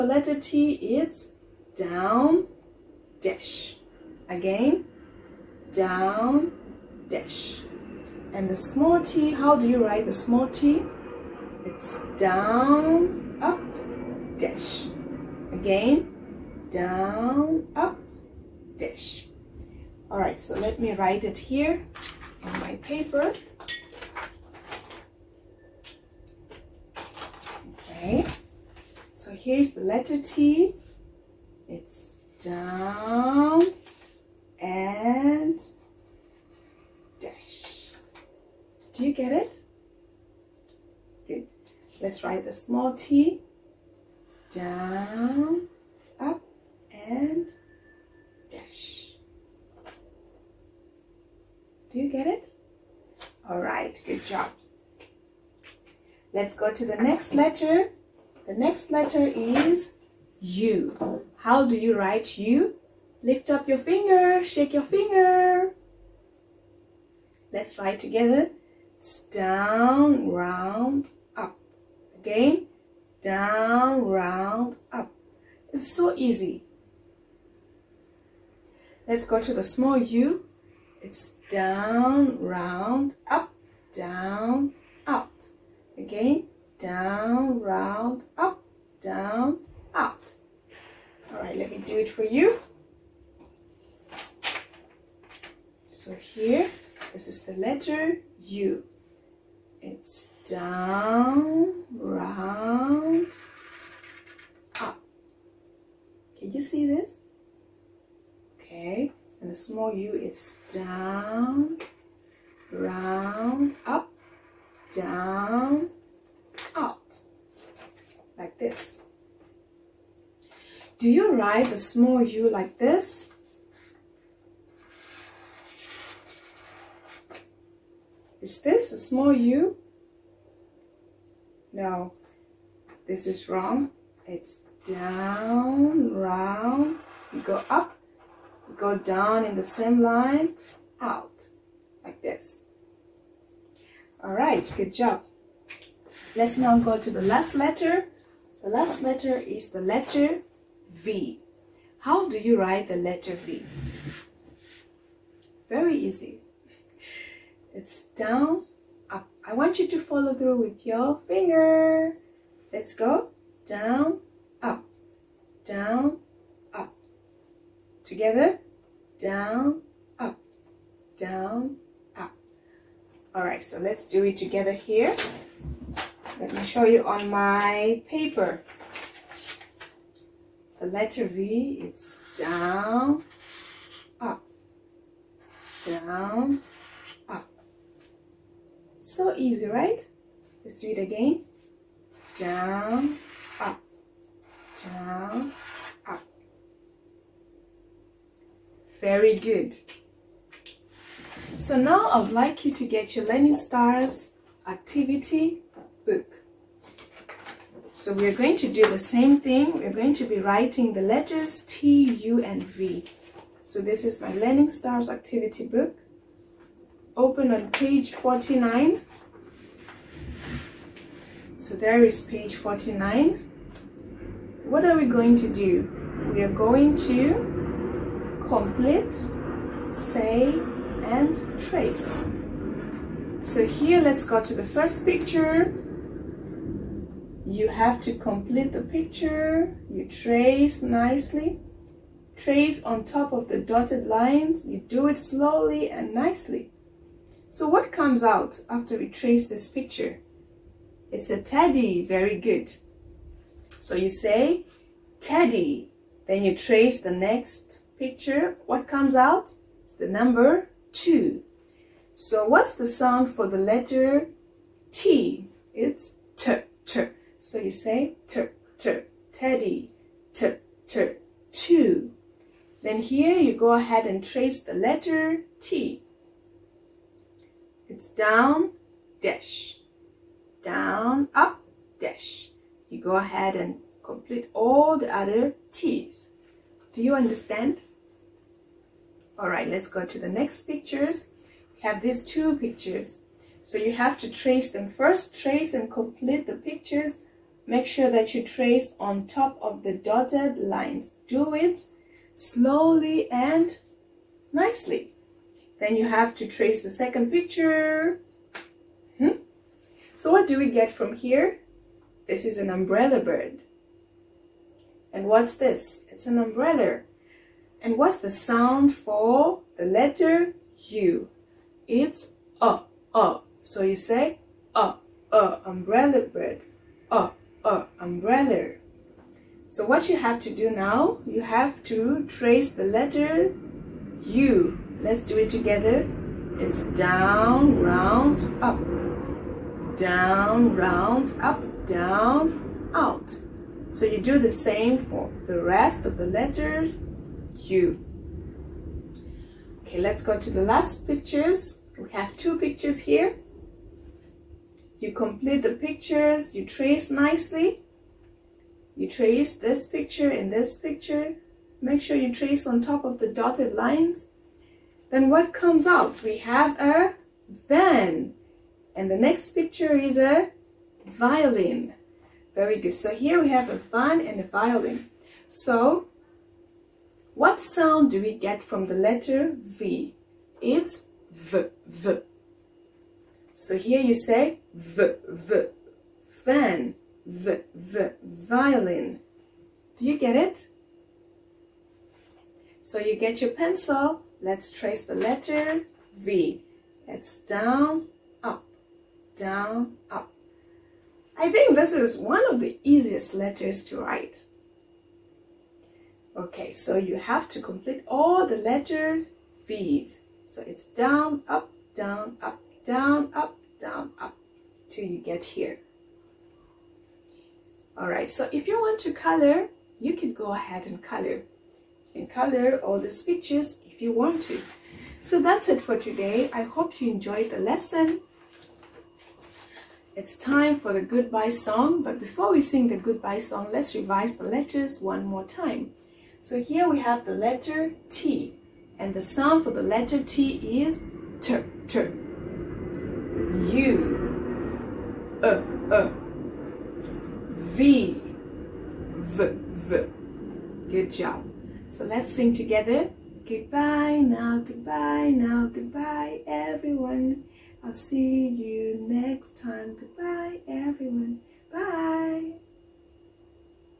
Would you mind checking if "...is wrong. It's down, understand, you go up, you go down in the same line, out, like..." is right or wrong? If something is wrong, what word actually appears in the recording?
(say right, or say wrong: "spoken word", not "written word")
wrong: "round", not "understand".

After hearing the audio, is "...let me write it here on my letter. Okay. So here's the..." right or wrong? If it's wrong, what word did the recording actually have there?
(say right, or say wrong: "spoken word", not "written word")
wrong: "paper", not "letter".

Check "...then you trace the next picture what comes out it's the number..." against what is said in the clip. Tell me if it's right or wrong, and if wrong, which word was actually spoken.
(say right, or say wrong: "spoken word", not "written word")
right.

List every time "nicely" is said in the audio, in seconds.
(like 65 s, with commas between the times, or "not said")
240 s, 246 s, 304 s, 357 s.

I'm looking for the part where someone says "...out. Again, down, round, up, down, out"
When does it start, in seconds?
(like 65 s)
85 s.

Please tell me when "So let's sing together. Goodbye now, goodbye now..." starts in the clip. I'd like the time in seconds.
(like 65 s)
451 s.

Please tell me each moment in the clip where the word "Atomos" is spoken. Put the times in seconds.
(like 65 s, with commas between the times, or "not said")
not said.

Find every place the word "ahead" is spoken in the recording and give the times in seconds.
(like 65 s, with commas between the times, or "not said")
273 s, 283 s, 420 s.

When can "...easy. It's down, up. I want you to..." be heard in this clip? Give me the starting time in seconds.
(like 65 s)
155 s.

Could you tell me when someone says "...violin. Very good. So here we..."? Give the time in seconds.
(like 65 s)
371 s.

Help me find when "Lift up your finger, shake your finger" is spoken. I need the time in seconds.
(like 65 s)
63 s.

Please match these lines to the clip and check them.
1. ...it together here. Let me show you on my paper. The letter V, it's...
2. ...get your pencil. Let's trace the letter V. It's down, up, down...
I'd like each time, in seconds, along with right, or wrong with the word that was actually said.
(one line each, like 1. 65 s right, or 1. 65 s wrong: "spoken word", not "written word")
1. 174 s right
2. 393 s right.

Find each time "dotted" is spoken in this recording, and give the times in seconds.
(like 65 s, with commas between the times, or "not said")
243 s, 299 s, 363 s.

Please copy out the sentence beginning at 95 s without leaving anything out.
So here, this is the letter U.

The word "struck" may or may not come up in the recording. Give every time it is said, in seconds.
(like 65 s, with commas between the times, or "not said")
not said.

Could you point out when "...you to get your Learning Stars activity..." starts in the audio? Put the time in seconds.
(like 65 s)
202 s.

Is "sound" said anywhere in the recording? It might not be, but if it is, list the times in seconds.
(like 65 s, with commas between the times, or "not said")
262 s, 318 s, 377 s, 439 s.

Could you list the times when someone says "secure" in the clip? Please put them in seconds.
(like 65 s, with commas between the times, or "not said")
not said.